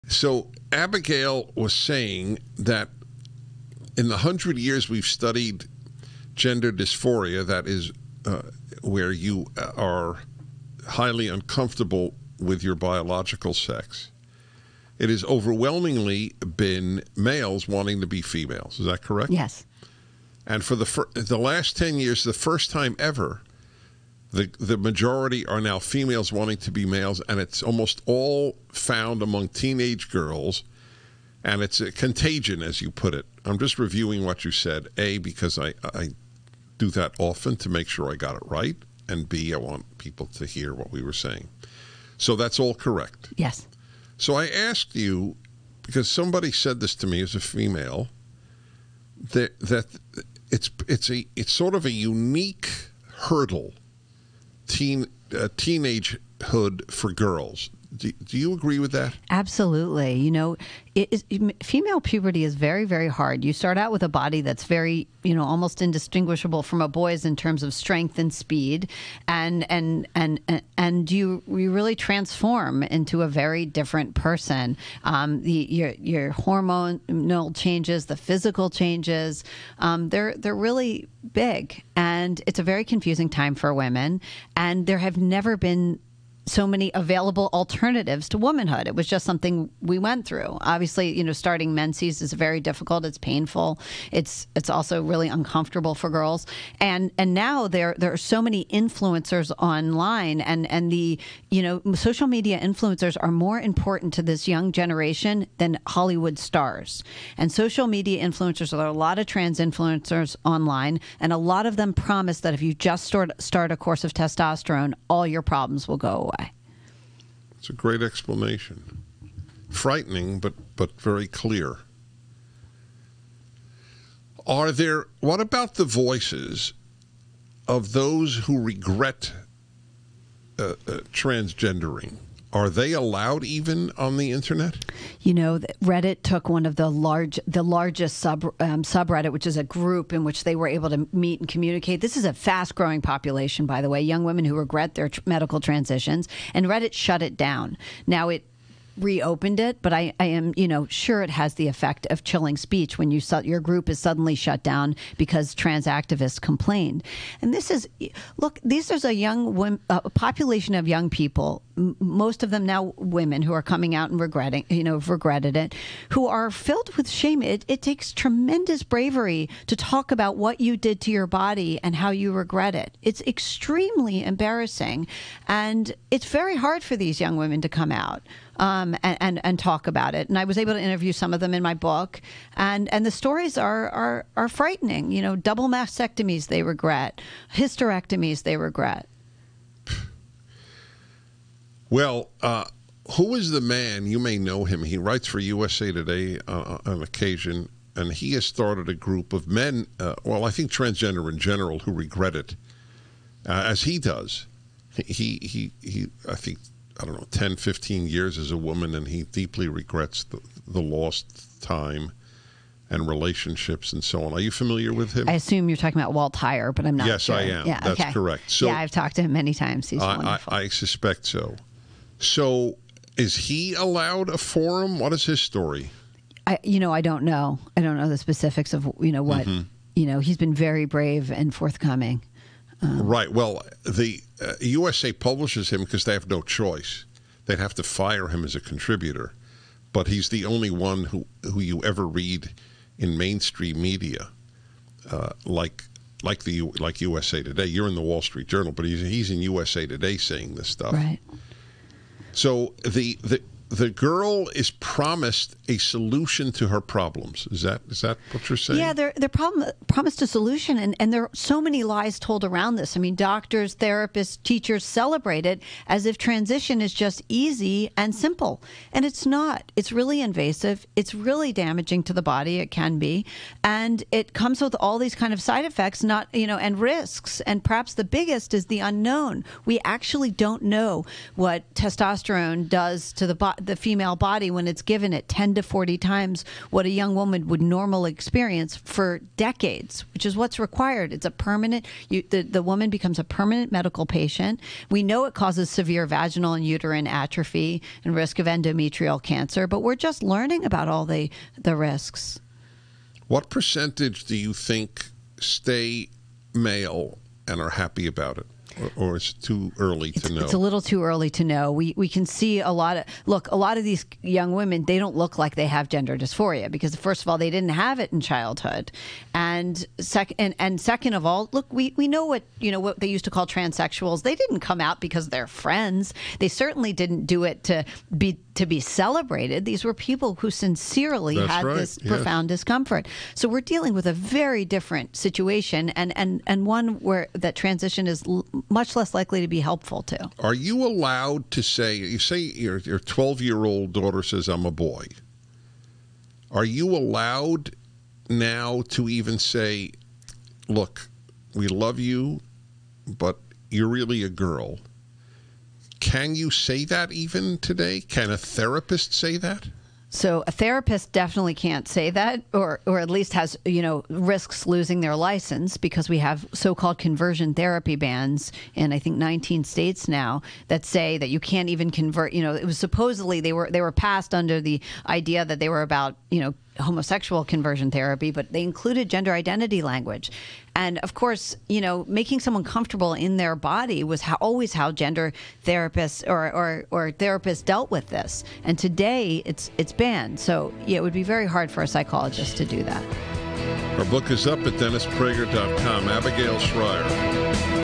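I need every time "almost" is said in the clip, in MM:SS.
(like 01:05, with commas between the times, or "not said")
00:27, 01:05.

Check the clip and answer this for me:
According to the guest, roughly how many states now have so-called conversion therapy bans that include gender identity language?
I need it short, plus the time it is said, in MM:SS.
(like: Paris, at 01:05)
19, at 06:09.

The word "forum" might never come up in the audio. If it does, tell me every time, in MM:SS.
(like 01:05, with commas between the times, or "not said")
03:44.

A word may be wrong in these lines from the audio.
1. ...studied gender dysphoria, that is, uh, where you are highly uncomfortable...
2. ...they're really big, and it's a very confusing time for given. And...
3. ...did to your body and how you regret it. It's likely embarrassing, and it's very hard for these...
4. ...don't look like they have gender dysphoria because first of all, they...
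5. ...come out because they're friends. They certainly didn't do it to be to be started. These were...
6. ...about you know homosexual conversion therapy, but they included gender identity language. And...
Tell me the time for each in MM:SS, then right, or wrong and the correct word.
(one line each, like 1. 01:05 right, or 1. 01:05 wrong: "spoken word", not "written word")
1. 00:05 right
2. 01:20 wrong: "women", not "given"
3. 02:50 wrong: "extremely", not "likely"
4. 05:14 right
5. 05:24 wrong: "celebrated", not "started"
6. 06:15 right.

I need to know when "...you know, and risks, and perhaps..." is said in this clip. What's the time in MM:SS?
04:36.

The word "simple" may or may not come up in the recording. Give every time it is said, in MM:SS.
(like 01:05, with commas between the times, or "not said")
04:28.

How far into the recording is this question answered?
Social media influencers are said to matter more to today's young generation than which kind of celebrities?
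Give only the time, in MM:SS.
01:45.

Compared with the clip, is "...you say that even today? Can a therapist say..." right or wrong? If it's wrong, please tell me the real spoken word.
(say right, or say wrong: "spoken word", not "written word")
right.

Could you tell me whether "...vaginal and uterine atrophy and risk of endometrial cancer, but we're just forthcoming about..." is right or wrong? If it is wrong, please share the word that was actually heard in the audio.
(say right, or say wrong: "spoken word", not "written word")
wrong: "learning", not "forthcoming".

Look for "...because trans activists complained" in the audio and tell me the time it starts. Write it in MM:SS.
02:35.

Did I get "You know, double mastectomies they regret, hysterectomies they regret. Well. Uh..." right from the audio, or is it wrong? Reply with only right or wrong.
right.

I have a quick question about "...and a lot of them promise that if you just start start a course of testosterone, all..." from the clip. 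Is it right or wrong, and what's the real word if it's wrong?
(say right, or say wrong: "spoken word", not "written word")
right.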